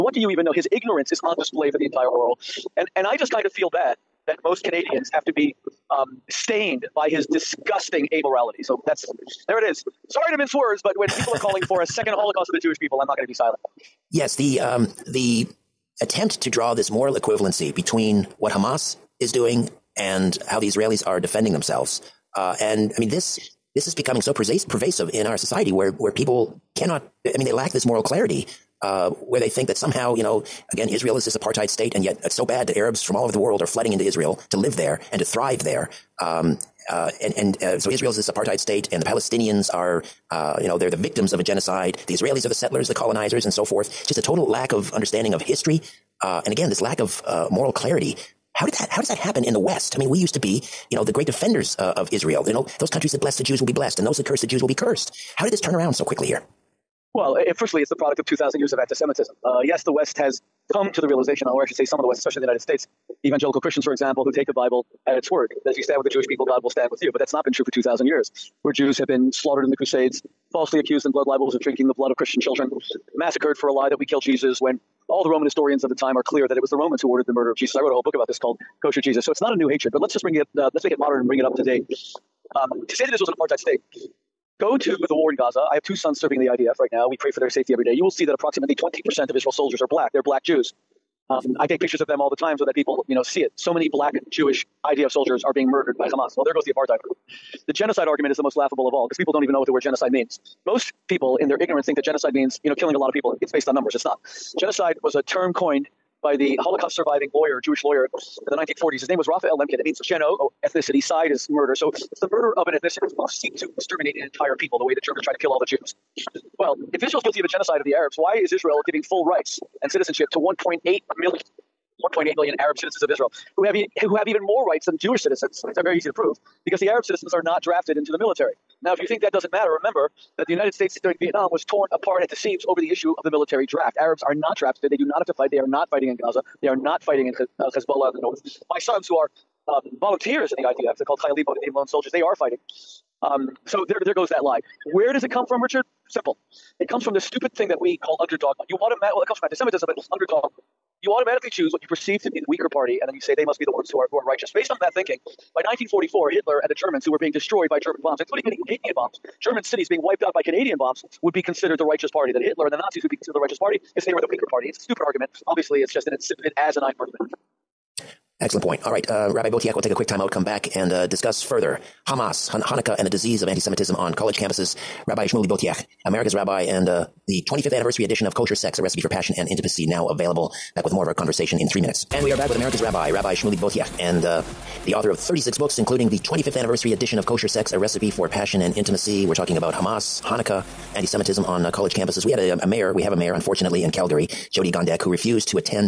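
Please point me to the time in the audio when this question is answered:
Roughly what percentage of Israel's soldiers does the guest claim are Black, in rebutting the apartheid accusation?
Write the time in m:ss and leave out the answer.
1:28.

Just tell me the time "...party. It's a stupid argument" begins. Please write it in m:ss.
2:44.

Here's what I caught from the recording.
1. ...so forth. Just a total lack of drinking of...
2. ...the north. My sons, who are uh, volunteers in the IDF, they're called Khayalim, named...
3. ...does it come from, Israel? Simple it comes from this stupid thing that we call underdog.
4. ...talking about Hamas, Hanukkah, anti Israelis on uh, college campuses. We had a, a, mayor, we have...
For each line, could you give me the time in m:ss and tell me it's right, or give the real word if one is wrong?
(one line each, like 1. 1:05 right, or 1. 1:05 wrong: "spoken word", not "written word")
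1. 0:43 wrong: "understanding", not "drinking"
2. 2:18 right
3. 2:25 wrong: "Richard", not "Israel"
4. 3:09 wrong: "Semitism", not "Israelis".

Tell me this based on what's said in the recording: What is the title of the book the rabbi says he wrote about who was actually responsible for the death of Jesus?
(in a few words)
Kosher Jesus.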